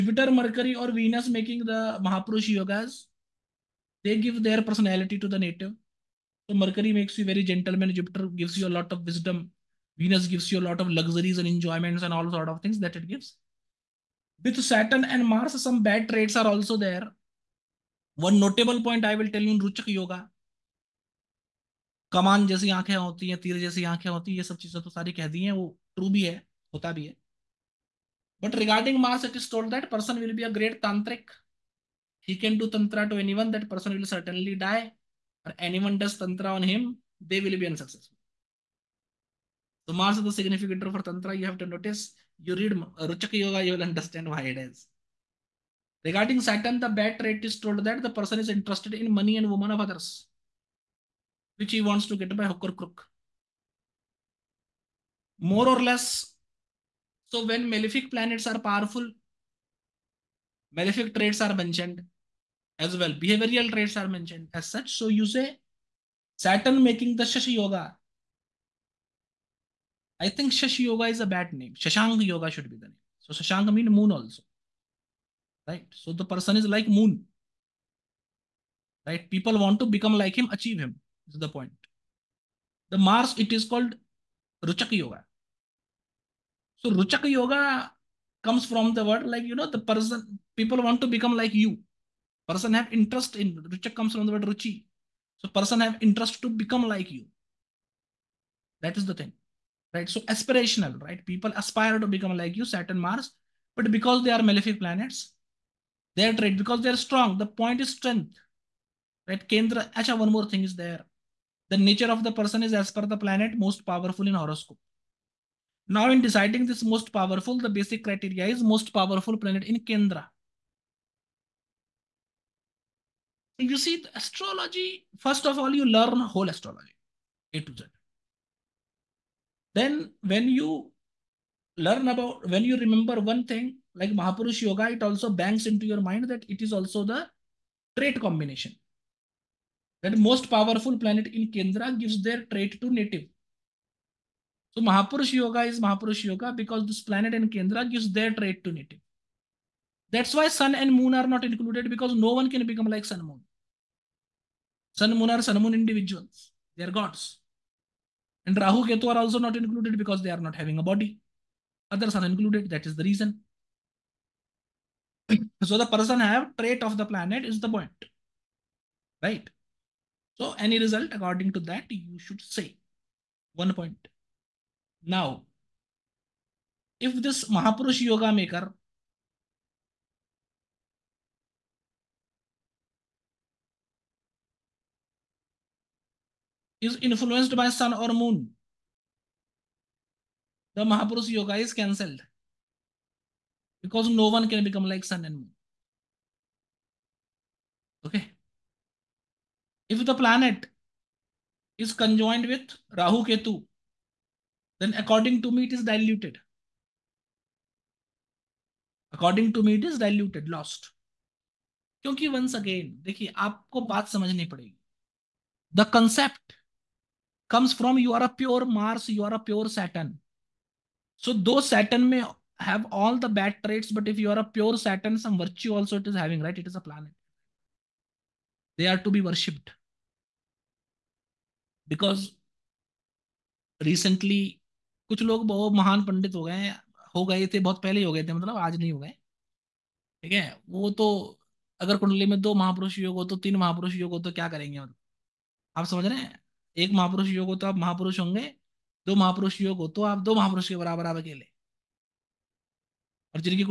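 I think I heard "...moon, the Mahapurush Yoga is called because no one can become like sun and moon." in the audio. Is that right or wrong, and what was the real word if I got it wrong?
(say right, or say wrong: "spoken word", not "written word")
wrong: "cancelled", not "called".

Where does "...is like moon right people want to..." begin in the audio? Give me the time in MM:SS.
01:16.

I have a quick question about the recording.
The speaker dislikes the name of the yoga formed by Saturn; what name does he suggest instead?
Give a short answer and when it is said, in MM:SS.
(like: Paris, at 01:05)
Shashank Yoga, at 01:11.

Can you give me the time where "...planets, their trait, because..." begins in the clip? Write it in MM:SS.
01:44.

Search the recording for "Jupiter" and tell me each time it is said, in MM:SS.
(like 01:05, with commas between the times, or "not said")
00:07.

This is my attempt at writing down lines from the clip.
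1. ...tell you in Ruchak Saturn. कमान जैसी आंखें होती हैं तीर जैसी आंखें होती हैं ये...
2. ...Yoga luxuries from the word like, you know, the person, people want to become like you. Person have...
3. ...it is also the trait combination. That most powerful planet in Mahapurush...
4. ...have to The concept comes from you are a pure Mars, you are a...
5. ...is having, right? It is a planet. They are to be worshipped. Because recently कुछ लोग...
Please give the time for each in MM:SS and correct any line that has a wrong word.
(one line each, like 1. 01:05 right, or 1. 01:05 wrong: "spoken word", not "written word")
1. 00:19 wrong: "Yoga", not "Saturn"
2. 01:27 wrong: "comes", not "luxuries"
3. 02:16 wrong: "Kendra", not "Mahapurush"
4. 03:33 right
5. 03:46 right.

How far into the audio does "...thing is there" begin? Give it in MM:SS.
01:50.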